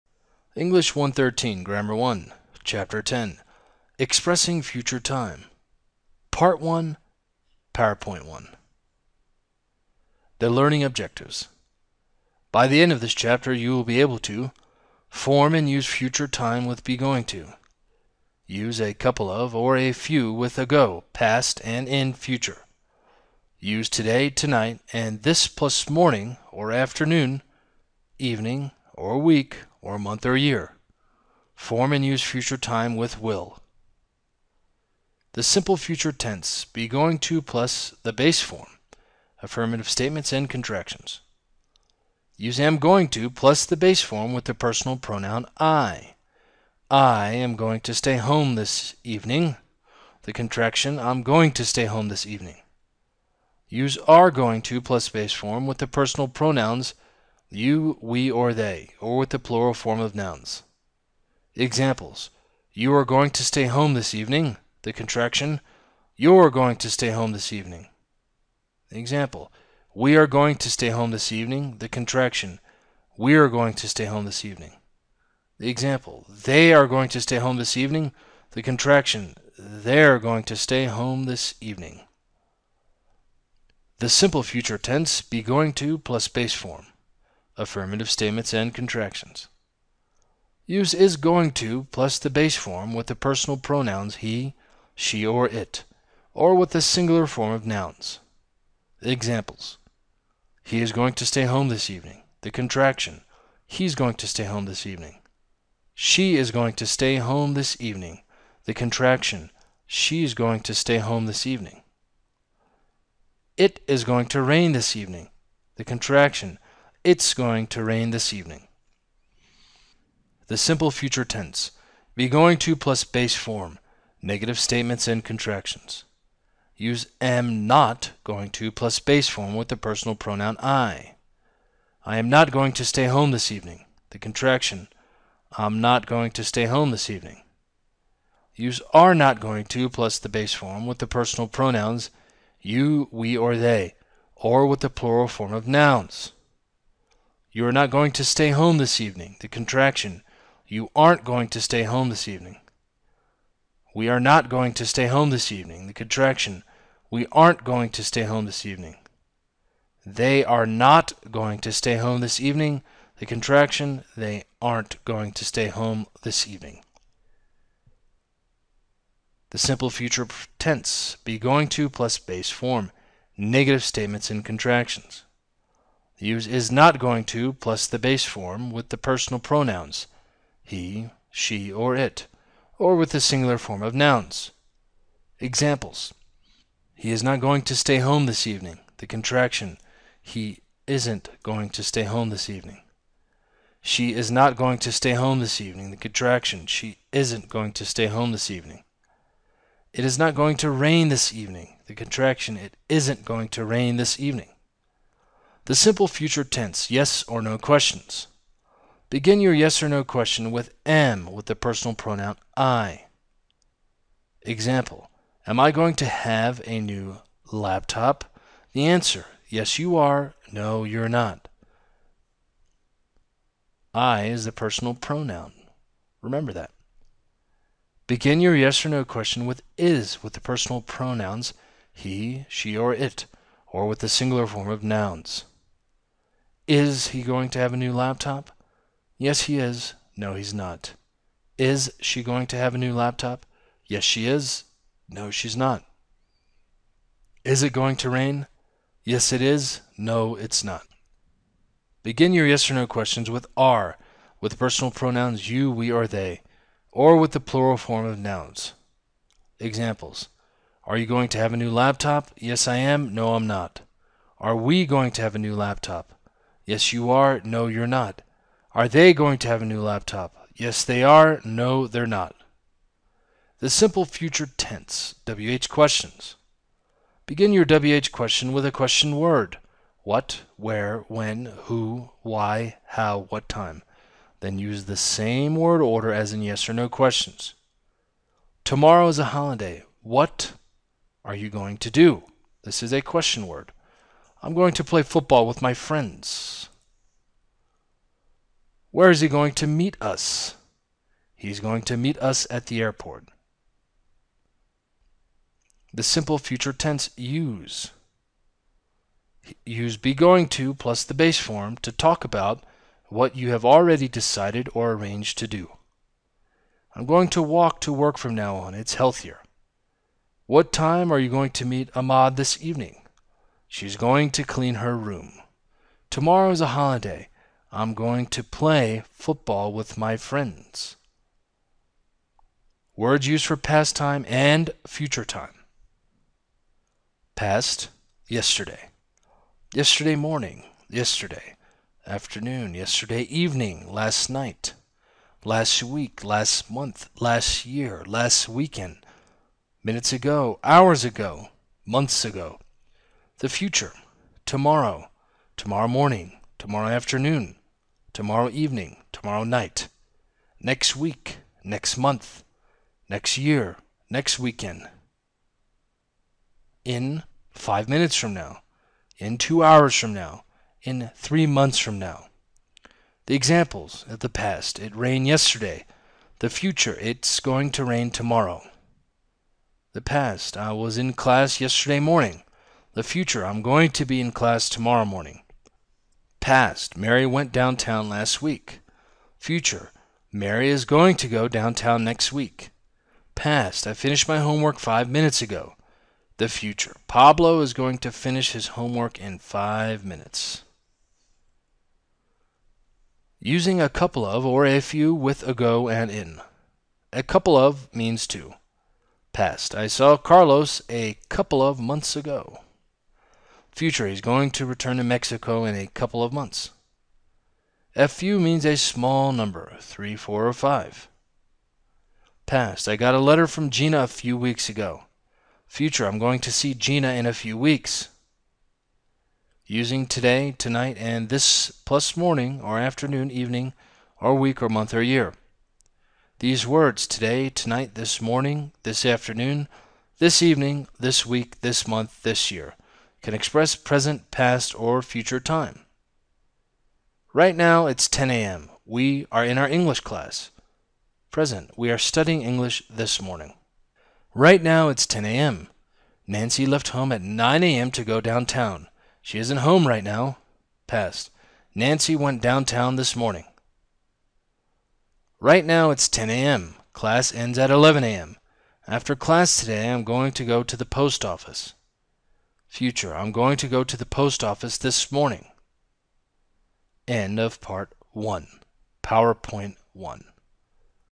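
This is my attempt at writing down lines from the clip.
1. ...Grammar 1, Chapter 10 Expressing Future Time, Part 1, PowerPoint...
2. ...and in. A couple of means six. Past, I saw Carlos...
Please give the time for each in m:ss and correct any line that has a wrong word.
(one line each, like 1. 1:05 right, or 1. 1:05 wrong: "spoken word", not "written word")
1. 0:01 right
2. 6:45 wrong: "two", not "six".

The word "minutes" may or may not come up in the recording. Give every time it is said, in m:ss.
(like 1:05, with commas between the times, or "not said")
5:49, 6:07, 6:35, 6:40.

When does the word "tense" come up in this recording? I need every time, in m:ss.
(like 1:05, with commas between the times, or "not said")
0:36, 1:24, 2:01, 2:50, 3:26, 4:34, 5:06.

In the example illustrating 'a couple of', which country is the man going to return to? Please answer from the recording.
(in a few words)
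Mexico.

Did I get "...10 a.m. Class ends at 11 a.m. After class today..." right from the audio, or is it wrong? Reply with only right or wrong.
right.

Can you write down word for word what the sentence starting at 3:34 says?
Example, am I going to have a new laptop?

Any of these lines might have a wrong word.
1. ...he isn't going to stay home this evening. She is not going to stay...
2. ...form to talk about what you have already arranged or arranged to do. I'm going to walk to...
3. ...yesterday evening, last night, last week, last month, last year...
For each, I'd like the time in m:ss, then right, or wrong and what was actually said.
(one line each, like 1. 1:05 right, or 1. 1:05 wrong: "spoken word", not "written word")
1. 3:10 right
2. 5:11 wrong: "decided", not "arranged"
3. 5:42 right.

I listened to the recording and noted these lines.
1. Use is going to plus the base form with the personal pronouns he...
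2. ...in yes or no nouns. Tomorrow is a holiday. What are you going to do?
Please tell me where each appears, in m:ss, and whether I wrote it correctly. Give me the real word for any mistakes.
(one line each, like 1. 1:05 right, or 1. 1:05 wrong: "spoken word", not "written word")
1. 1:30 right
2. 4:46 wrong: "questions", not "nouns".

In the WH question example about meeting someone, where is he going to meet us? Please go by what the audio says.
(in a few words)
at the airport.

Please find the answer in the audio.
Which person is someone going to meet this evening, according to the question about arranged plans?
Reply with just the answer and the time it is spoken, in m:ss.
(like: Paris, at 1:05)
Ahmad, at 5:21.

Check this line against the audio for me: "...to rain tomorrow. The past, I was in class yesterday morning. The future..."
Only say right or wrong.
right.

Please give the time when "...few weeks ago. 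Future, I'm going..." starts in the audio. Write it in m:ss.
7:04.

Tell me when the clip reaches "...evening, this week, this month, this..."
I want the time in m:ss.
7:20.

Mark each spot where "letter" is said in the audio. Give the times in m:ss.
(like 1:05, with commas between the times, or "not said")
7:03.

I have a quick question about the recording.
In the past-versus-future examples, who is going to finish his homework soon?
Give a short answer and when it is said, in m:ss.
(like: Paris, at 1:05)
Pablo, at 6:37.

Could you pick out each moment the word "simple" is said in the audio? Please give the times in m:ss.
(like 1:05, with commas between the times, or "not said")
0:35, 1:24, 2:00, 2:49, 3:25, 4:33, 5:06.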